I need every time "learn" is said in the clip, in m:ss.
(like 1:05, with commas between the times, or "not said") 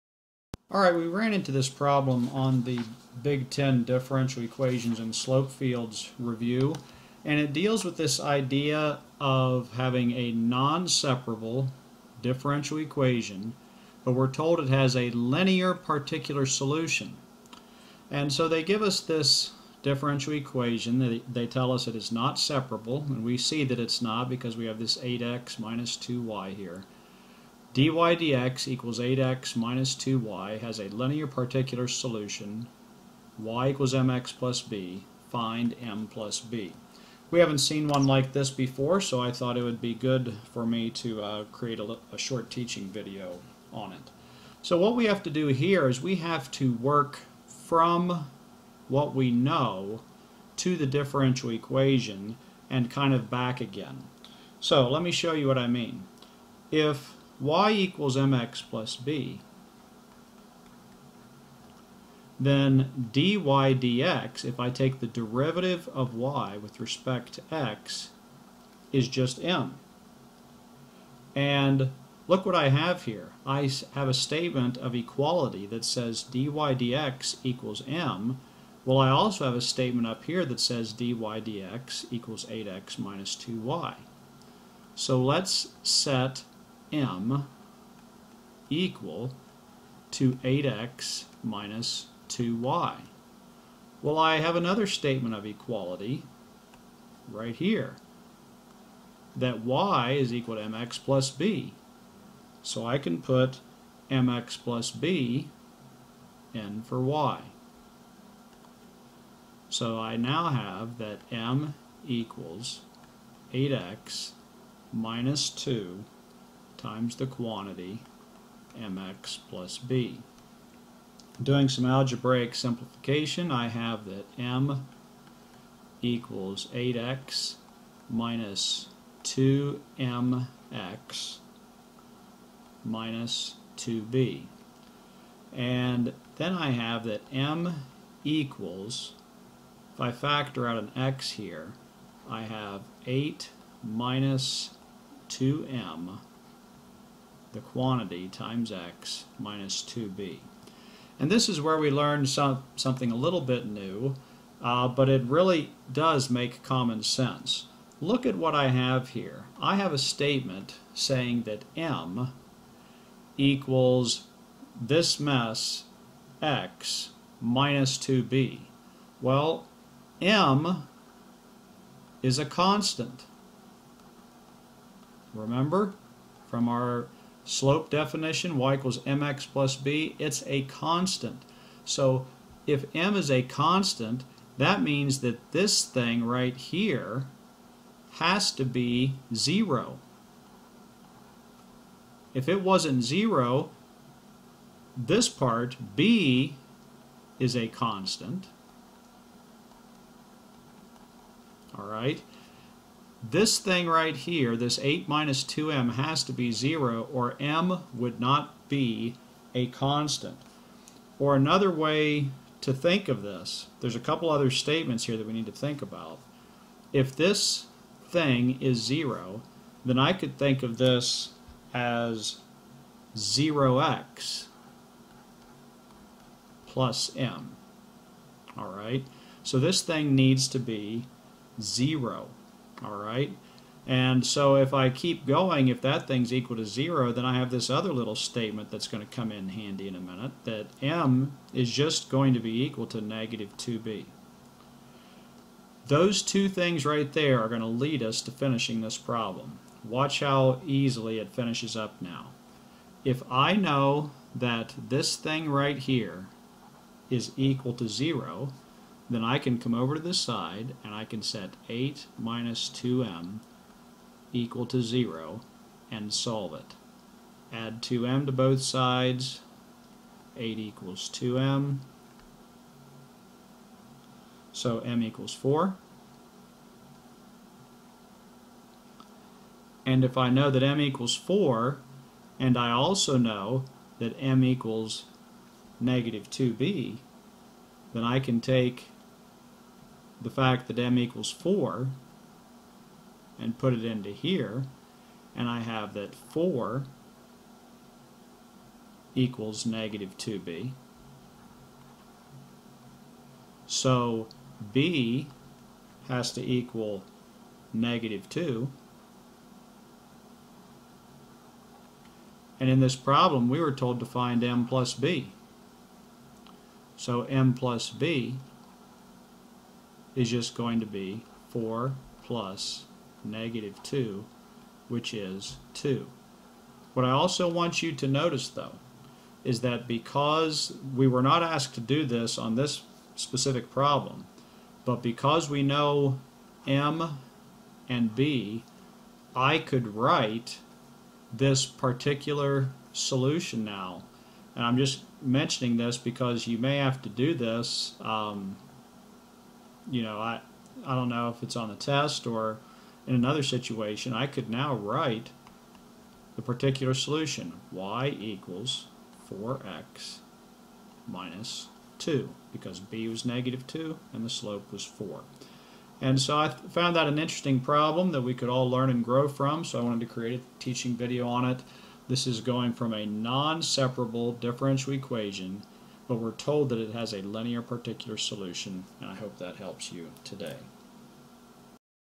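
2:31, 6:08.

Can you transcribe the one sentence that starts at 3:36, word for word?
If this thing is 0, then I could think of this as 0x plus m.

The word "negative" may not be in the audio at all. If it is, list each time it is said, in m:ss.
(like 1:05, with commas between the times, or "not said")
4:03, 4:45, 4:59, 5:07, 5:23, 6:03.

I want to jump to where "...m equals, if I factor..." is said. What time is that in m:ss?
2:17.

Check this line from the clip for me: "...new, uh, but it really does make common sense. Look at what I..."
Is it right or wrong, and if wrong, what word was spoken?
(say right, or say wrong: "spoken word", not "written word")
right.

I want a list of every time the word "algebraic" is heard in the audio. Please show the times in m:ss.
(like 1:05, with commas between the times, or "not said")
2:01.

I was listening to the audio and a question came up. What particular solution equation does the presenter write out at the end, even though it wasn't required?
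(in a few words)
y = 4x - 2.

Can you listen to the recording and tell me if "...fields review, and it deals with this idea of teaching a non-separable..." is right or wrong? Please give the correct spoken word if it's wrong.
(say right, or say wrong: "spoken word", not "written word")
wrong: "having", not "teaching".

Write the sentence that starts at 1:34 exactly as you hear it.
Well, I have another statement of equality right here that y is equal to mx plus b.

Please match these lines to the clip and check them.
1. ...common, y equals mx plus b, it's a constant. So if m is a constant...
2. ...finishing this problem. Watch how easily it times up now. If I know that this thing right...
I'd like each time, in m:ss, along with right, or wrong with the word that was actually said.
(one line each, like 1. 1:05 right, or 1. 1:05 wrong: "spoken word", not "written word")
1. 2:57 wrong: "definition", not "common"
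2. 4:08 wrong: "finishes", not "times".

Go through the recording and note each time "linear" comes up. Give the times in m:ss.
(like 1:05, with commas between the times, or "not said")
0:15, 0:30, 6:17.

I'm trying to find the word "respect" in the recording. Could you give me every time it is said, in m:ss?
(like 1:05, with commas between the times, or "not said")
1:06.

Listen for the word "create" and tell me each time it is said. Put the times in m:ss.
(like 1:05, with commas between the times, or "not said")
0:41, 6:10.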